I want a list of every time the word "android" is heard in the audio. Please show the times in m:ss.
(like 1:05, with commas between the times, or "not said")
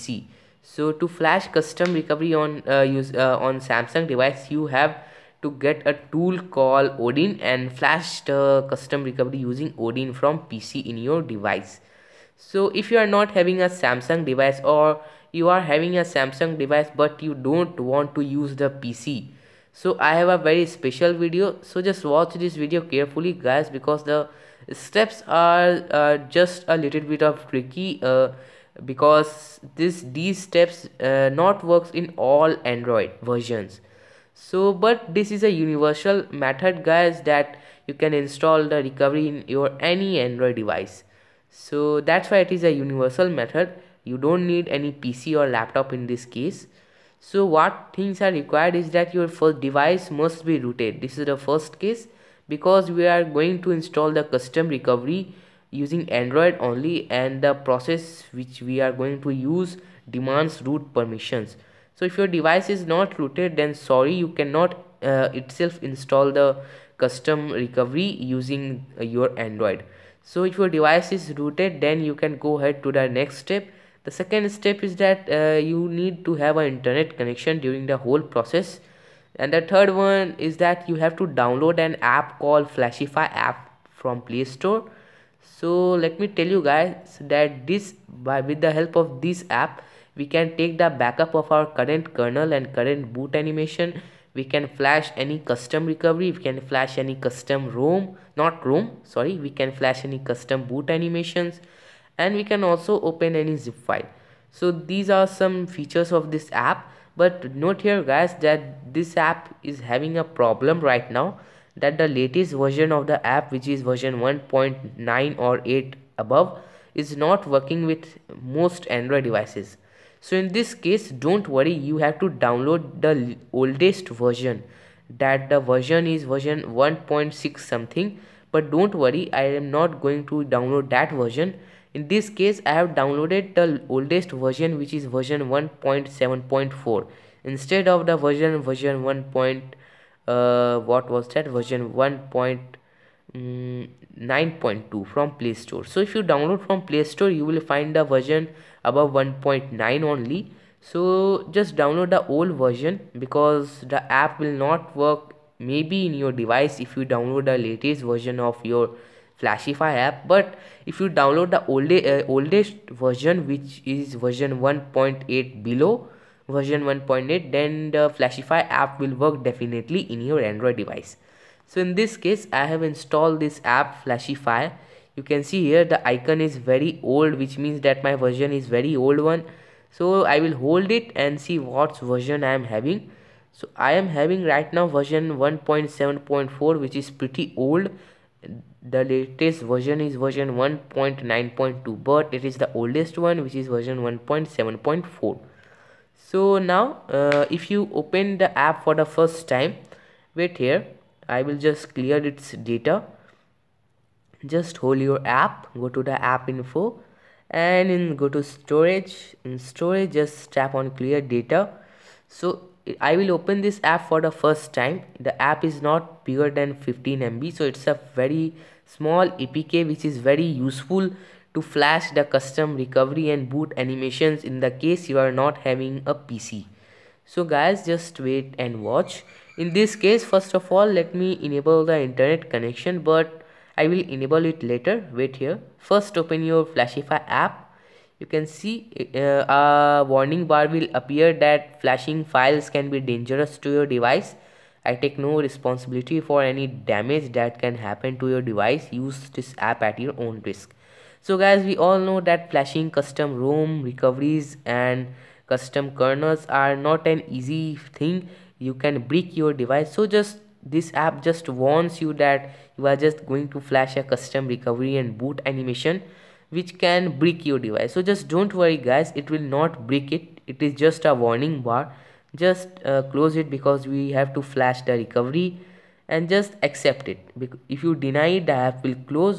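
0:32, 0:40, 0:56, 1:09, 1:58, 2:50.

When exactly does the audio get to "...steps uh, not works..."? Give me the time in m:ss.
0:30.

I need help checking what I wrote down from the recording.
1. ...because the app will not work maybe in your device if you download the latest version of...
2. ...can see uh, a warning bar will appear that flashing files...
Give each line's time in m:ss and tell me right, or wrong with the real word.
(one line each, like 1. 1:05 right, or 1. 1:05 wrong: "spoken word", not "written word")
1. 2:33 right
2. 3:58 right.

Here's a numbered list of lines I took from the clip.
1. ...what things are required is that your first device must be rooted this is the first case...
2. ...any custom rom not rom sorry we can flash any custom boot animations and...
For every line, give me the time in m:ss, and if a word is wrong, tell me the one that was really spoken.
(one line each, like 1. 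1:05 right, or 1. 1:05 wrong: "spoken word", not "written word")
1. 0:47 right
2. 1:36 right.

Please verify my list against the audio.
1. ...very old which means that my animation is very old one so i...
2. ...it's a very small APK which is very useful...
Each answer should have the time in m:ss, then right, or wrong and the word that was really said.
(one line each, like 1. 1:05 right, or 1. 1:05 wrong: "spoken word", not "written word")
1. 2:56 wrong: "version", not "animation"
2. 3:37 right.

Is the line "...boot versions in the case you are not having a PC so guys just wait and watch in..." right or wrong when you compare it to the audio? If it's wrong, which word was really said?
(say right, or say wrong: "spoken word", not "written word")
wrong: "animations", not "versions".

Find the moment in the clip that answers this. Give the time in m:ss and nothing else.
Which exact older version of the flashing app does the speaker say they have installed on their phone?
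2:15.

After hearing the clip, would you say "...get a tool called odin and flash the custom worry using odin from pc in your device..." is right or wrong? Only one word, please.
wrong.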